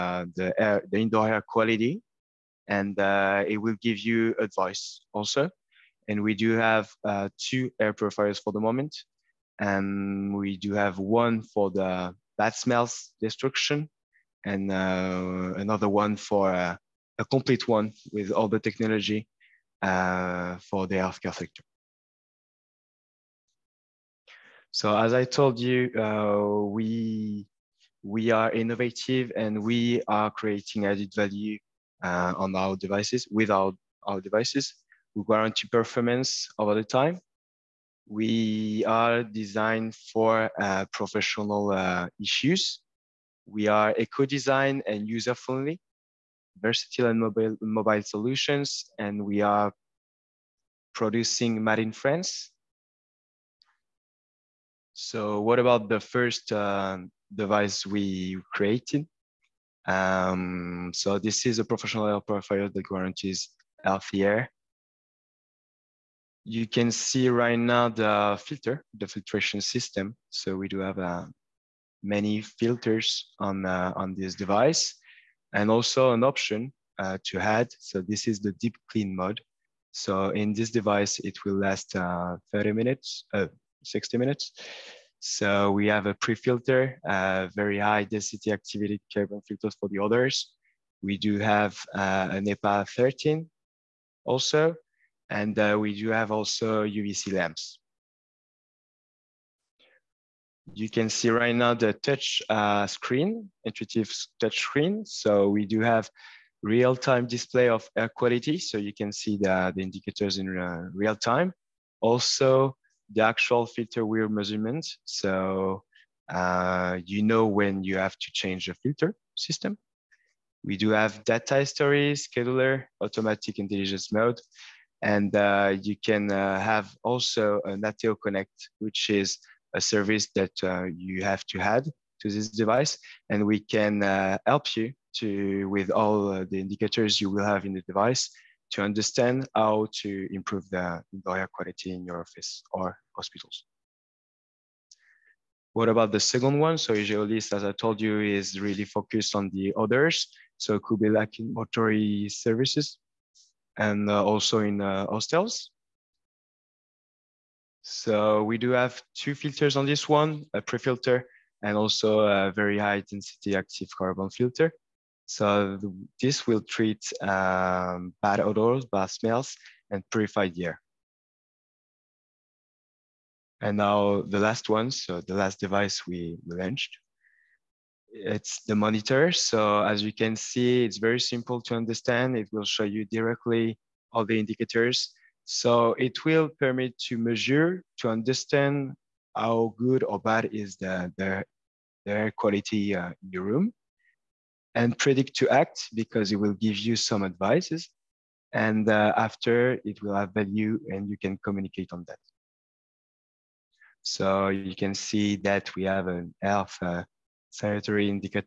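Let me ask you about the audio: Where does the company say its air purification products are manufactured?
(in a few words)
France.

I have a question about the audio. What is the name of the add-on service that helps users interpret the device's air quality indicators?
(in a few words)
Ateo Connect.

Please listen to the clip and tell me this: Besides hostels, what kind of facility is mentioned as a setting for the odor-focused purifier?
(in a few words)
mortuary services.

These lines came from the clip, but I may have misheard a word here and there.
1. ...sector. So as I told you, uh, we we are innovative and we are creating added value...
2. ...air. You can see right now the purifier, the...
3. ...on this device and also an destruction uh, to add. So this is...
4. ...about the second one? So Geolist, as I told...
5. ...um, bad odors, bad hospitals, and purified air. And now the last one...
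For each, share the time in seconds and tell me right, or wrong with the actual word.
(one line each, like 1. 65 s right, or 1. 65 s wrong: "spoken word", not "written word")
1. 21 s right
2. 64 s wrong: "filter", not "purifier"
3. 73 s wrong: "option", not "destruction"
4. 145 s right
5. 167 s wrong: "smells", not "hospitals".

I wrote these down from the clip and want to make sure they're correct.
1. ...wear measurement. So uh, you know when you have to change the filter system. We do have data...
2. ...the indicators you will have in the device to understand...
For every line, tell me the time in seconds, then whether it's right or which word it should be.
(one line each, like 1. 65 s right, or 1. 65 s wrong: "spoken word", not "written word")
1. 114 s right
2. 136 s right.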